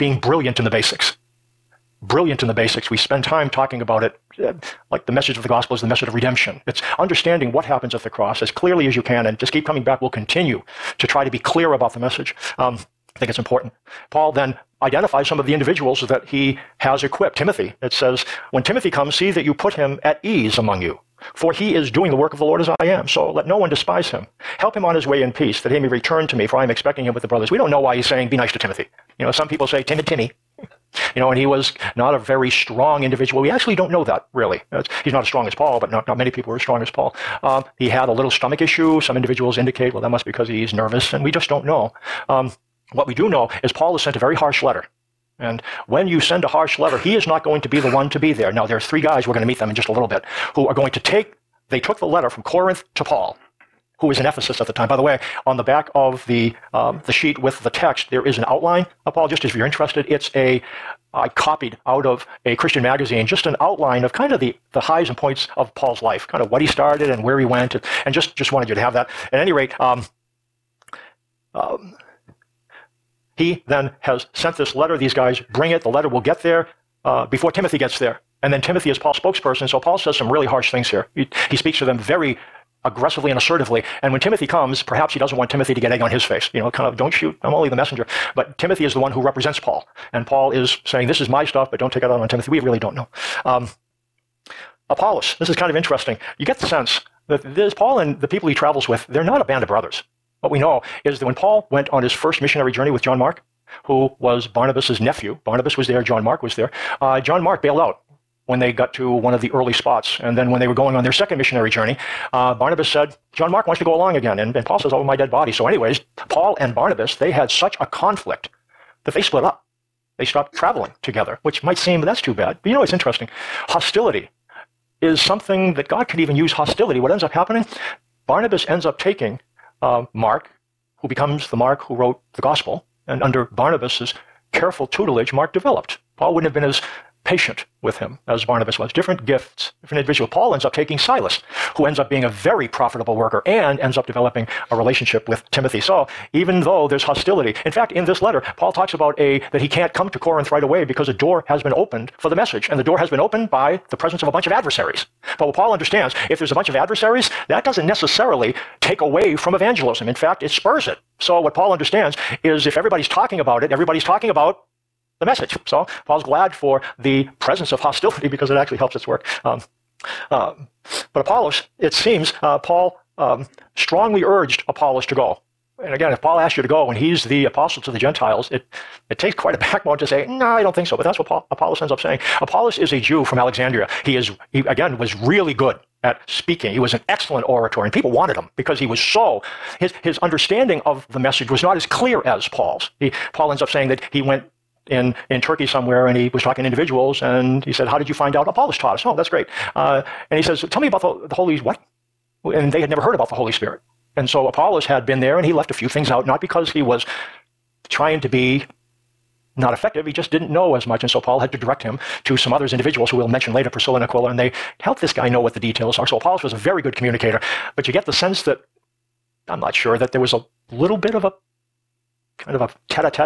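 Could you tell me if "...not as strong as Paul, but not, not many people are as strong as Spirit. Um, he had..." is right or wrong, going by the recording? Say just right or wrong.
wrong.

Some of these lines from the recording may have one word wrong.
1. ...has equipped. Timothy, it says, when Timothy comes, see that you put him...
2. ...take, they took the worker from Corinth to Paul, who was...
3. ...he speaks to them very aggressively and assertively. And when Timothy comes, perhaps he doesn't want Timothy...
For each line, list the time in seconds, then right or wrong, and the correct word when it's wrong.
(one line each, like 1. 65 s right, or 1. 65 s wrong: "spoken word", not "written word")
1. 16 s right
2. 50 s wrong: "letter", not "worker"
3. 81 s right.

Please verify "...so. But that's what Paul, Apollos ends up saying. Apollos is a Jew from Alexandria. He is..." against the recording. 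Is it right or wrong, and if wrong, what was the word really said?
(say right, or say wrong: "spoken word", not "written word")
right.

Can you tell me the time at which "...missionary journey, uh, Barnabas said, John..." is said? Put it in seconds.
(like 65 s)
111 s.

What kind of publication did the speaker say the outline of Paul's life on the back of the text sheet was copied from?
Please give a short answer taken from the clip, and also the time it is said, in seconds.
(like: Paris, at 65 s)
A Christian magazine, at 62 s.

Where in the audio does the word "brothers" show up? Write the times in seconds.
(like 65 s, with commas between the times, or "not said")
27 s, 99 s.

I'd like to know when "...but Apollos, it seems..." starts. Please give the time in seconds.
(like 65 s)
171 s.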